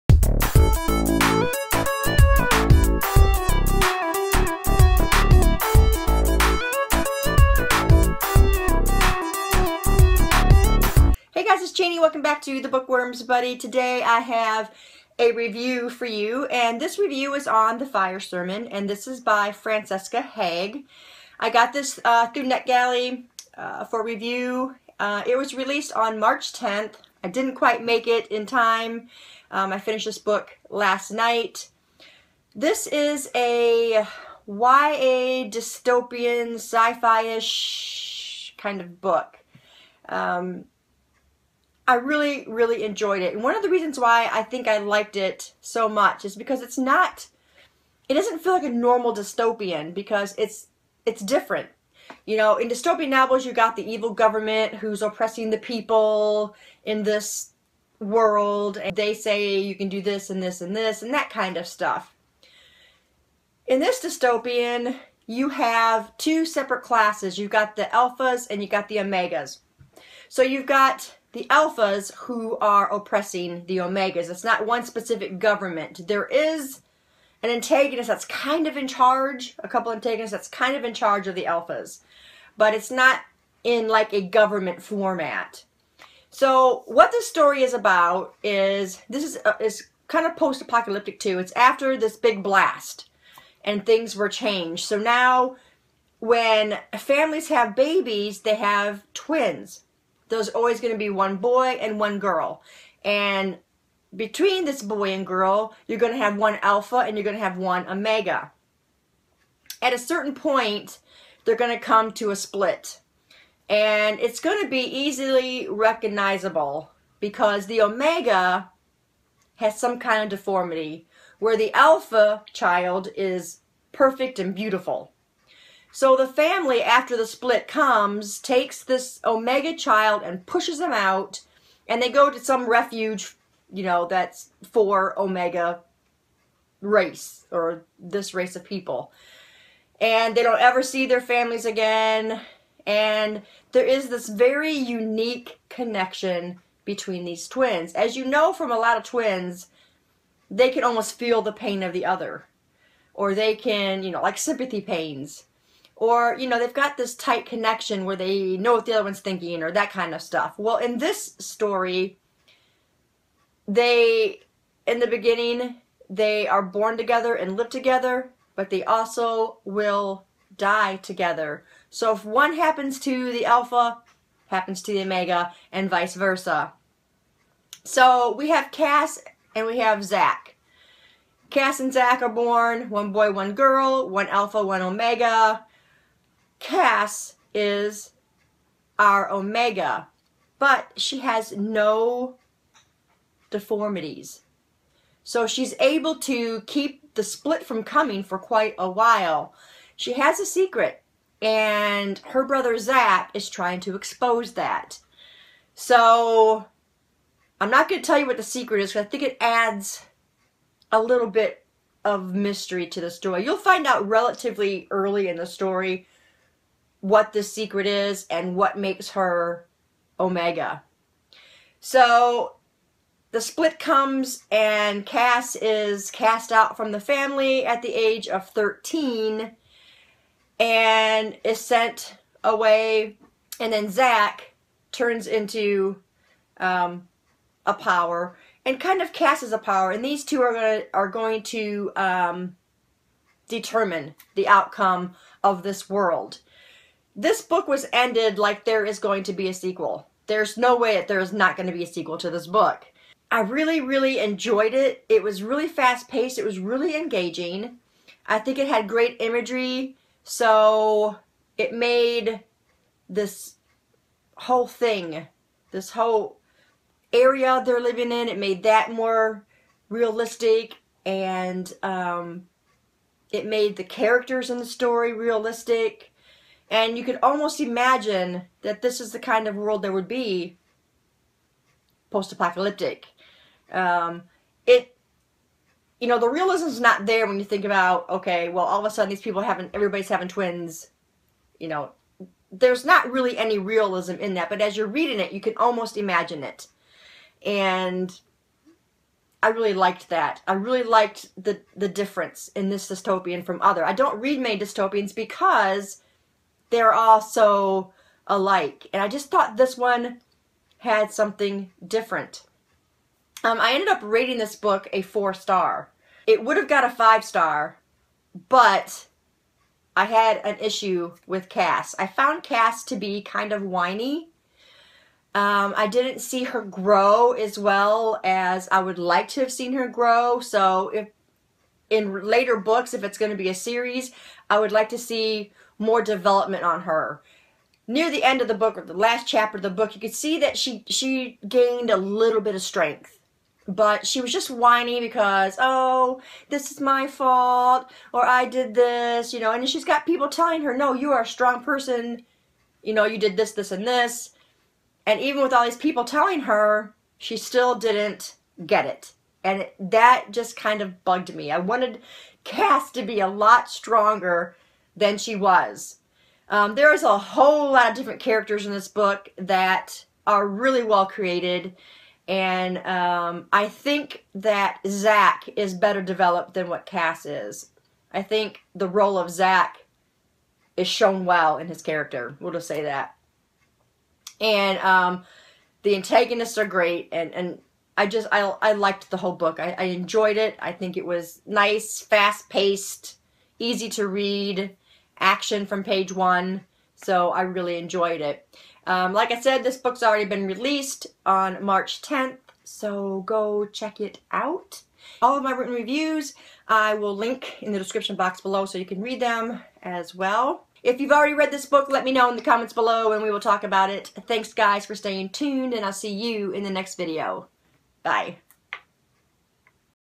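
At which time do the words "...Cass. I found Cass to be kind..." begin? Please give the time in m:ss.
5:21.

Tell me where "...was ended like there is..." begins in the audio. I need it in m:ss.
4:07.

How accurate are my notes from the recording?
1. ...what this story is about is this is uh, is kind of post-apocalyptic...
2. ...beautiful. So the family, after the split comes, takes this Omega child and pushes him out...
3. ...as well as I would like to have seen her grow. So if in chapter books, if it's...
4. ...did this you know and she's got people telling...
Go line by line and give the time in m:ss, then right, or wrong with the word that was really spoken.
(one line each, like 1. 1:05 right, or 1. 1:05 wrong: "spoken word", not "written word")
1. 1:26 right
2. 2:04 right
3. 5:27 wrong: "later", not "chapter"
4. 5:48 right.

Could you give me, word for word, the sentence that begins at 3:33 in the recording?
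You'll find out relatively early in the story what the secret is and what makes her Omega.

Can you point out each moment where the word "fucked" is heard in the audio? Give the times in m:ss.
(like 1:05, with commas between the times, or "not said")
not said.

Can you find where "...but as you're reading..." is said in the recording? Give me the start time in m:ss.
4:54.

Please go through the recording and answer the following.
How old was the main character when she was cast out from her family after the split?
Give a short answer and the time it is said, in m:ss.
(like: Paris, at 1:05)
13, at 3:48.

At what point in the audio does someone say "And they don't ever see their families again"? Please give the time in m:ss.
2:19.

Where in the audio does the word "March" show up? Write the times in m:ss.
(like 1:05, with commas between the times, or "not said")
0:26, 6:41.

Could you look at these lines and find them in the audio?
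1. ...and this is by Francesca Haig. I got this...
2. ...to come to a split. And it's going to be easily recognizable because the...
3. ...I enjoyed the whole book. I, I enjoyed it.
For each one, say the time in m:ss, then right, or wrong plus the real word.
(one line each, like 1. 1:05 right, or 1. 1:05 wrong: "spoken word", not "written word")
1. 0:18 right
2. 1:51 right
3. 6:28 wrong: "liked", not "enjoyed".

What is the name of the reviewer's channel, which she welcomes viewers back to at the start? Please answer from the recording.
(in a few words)
The Bookworms Buddy.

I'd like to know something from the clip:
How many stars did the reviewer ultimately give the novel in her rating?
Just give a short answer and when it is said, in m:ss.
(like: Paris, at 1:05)
4, at 5:15.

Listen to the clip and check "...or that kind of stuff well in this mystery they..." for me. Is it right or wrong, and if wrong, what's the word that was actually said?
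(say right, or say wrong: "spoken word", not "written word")
wrong: "story", not "mystery".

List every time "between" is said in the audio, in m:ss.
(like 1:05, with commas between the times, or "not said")
1:44, 2:26.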